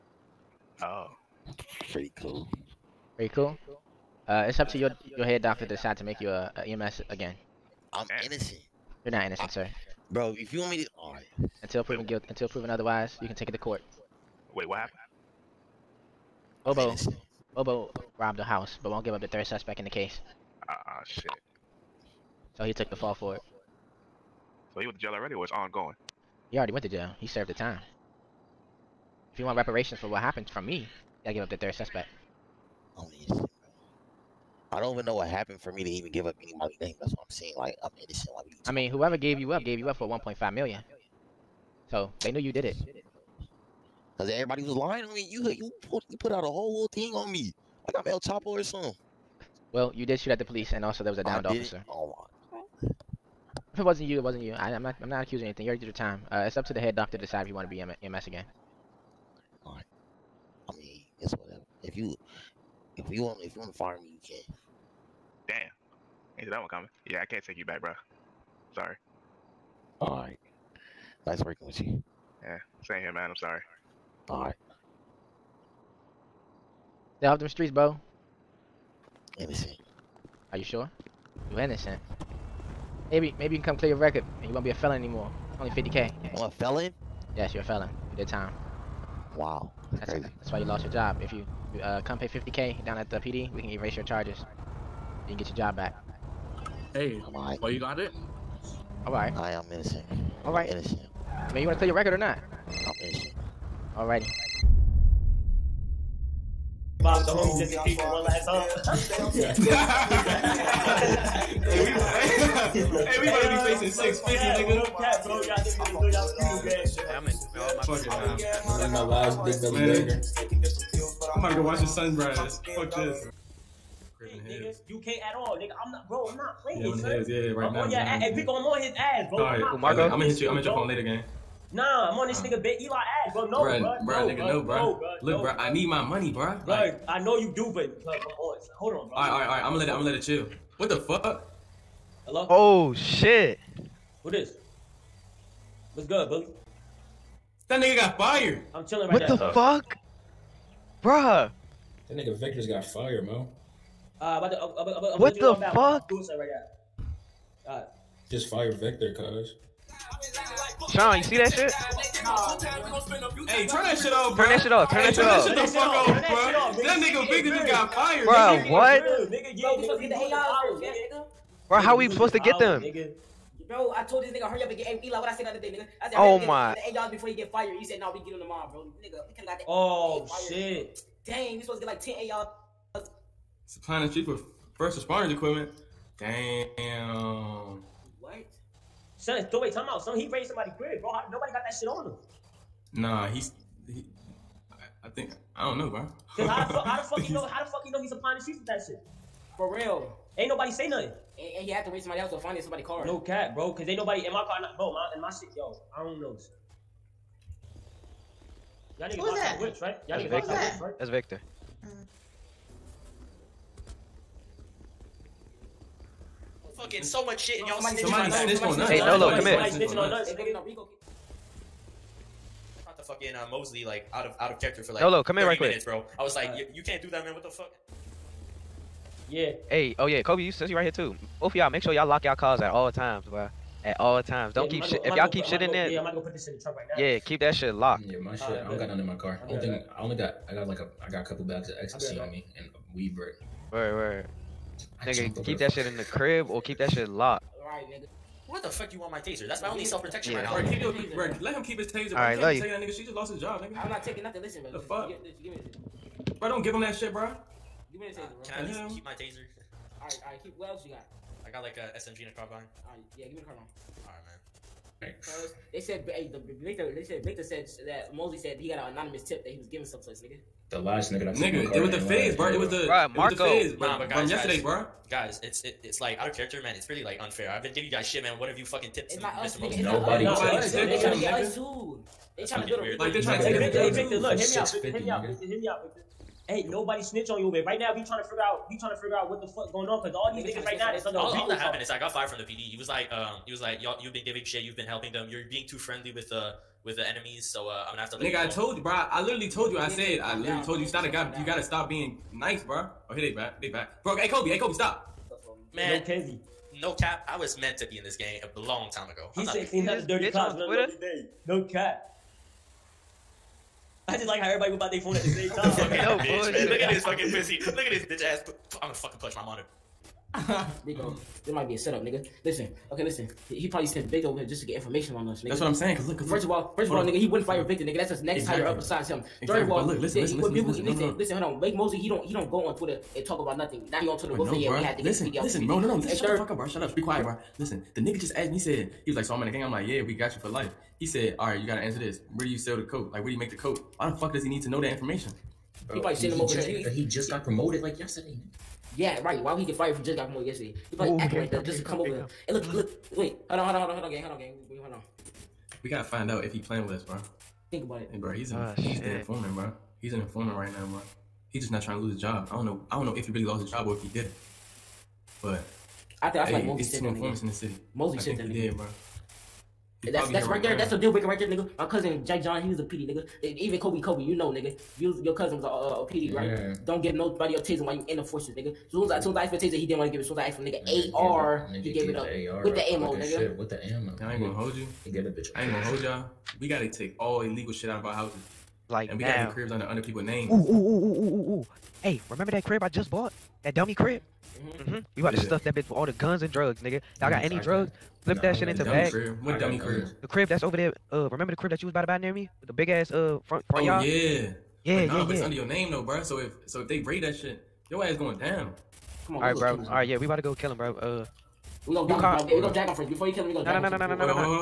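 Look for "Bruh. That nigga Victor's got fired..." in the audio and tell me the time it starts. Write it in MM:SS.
02:31.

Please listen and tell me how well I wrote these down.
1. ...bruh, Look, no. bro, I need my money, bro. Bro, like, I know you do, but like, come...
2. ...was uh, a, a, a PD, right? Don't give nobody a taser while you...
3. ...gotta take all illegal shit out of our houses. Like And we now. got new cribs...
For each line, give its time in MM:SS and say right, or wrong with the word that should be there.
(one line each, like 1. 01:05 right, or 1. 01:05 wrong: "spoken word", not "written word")
1. 02:15 right
2. 06:15 right
3. 06:26 right.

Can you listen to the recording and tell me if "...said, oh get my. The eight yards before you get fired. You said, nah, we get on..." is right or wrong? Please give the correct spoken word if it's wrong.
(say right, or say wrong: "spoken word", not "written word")
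right.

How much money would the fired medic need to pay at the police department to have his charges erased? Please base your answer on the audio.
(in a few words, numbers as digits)
50k.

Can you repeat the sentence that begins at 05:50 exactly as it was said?
He probably acting like that just to come over there.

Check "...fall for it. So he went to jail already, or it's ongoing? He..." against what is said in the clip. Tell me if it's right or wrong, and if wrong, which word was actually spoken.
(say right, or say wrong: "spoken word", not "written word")
right.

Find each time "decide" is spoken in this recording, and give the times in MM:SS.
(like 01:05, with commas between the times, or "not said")
00:05, 00:57.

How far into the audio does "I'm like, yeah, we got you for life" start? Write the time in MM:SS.
05:39.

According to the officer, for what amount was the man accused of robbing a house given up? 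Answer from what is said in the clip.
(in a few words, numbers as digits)
1.5 million.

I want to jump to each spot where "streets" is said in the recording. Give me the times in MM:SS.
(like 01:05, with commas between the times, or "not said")
01:17, 03:04, 03:18.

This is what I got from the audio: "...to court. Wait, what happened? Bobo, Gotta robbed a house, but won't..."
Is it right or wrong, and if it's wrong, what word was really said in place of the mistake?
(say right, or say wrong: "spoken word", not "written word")
wrong: "Bobo", not "Gotta".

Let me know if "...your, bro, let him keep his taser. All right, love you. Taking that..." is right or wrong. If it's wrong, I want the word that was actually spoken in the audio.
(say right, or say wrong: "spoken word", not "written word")
right.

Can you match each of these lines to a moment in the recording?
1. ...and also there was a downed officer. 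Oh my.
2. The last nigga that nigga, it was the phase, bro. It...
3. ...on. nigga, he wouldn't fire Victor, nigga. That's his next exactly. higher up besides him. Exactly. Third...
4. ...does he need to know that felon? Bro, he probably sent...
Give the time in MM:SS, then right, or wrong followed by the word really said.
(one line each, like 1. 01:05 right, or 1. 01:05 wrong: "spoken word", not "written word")
1. 00:50 right
2. 04:30 right
3. 05:26 right
4. 05:44 wrong: "information", not "felon".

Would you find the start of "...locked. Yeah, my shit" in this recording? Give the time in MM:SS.
03:57.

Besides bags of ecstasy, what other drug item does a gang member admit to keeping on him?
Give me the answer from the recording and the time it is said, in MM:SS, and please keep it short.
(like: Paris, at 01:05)
weed brick, at 04:02.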